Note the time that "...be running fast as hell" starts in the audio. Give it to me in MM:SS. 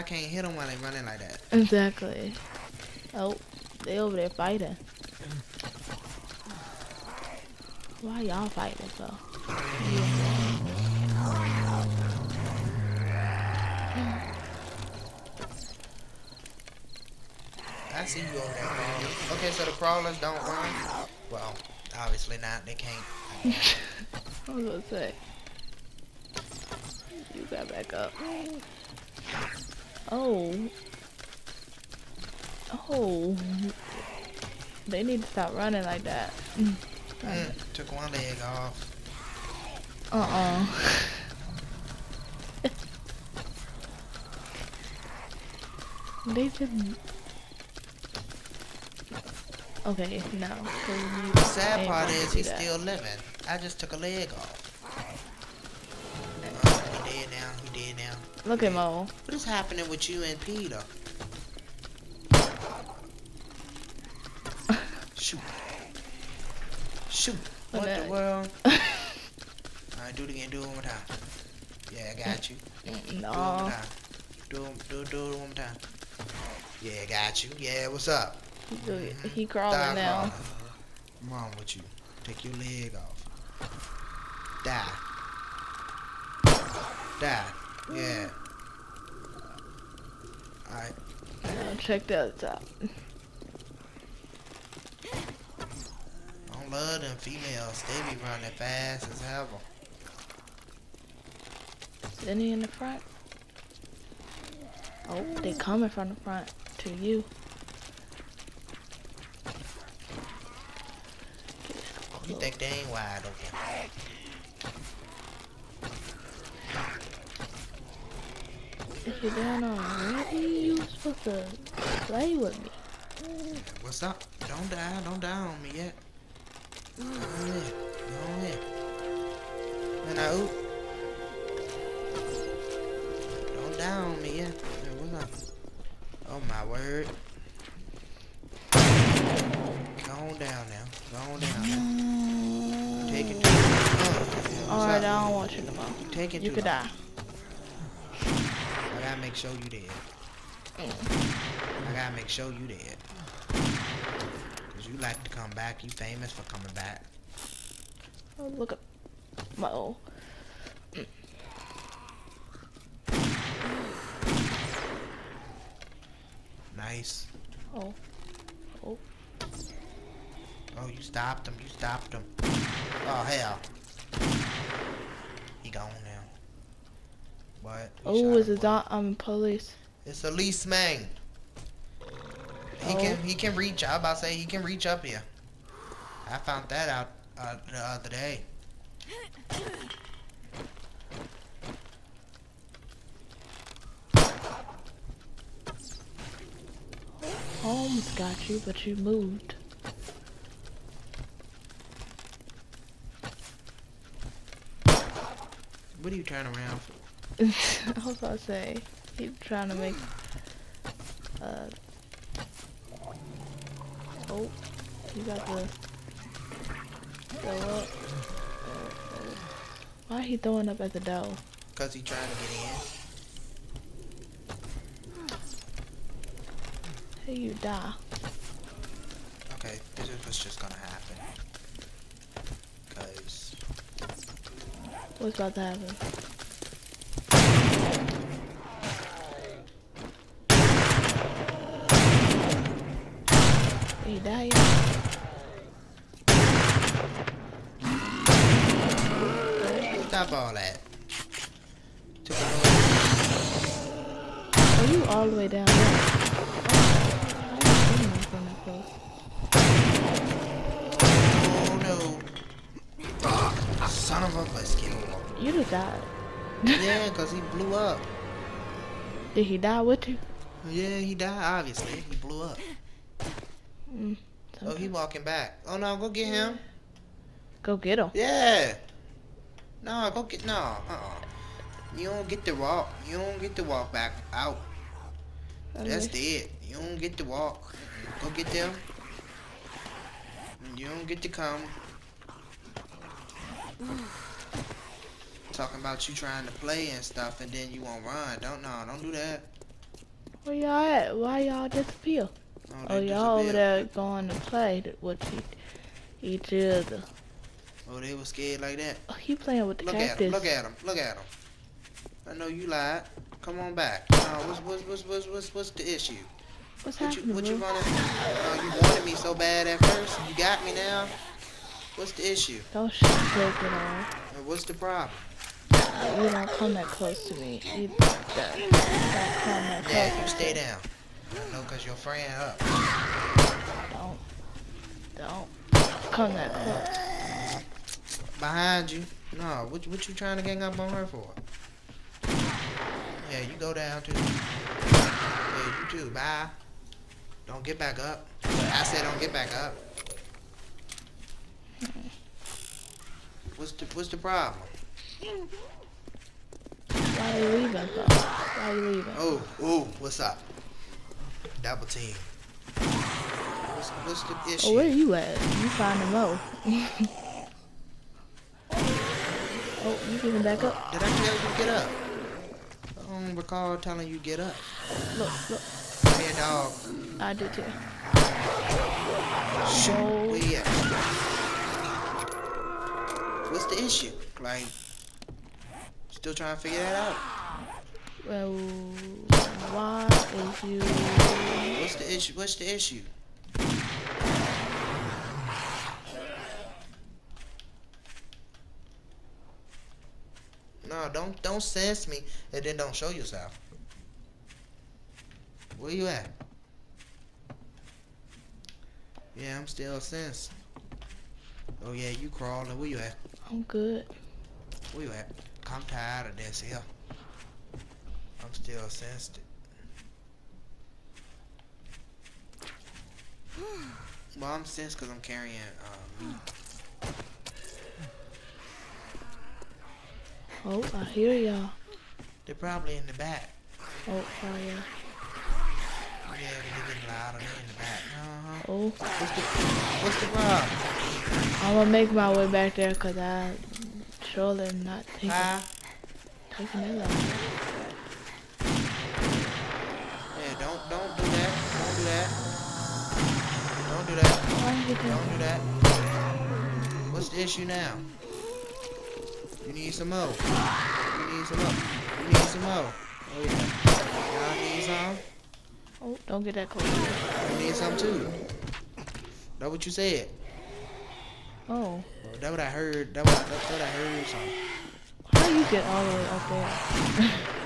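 01:38.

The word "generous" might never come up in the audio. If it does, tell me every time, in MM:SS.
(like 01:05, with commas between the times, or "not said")
not said.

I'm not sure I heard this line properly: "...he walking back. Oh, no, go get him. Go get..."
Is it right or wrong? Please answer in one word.
right.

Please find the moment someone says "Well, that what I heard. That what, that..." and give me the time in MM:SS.
07:52.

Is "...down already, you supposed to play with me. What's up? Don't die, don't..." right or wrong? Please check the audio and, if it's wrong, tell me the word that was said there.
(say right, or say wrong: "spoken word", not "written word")
right.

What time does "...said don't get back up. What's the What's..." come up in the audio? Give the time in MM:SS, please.
05:48.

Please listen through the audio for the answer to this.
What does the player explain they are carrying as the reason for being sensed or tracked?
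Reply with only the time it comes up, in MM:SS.
07:06.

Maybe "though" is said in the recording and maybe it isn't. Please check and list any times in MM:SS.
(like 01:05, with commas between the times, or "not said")
00:08, 05:57.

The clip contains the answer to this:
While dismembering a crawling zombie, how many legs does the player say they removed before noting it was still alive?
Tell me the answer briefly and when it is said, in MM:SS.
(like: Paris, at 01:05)
one leg, at 00:37.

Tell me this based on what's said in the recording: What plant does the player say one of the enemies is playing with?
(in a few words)
cactus.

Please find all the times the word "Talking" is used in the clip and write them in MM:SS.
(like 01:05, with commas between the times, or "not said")
04:55.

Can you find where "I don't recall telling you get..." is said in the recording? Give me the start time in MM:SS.
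06:12.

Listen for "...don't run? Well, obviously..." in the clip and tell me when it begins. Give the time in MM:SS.
00:20.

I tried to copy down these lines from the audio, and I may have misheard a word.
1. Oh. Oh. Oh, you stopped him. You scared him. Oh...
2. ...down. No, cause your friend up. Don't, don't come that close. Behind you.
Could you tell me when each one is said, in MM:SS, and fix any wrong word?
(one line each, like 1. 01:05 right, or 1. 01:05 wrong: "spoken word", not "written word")
1. 02:47 wrong: "stopped", not "scared"
2. 05:30 right.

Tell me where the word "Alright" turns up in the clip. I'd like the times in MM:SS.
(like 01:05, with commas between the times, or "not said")
01:08, 01:30.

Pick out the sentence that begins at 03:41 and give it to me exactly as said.
Cause he trying to get in.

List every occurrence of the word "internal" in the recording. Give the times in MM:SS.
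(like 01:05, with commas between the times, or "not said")
not said.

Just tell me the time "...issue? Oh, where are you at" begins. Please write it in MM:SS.
06:04.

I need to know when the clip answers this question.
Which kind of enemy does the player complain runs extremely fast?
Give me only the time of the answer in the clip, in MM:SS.
01:35.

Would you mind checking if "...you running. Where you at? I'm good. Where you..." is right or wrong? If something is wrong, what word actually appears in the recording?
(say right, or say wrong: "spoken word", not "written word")
wrong: "crawling", not "running".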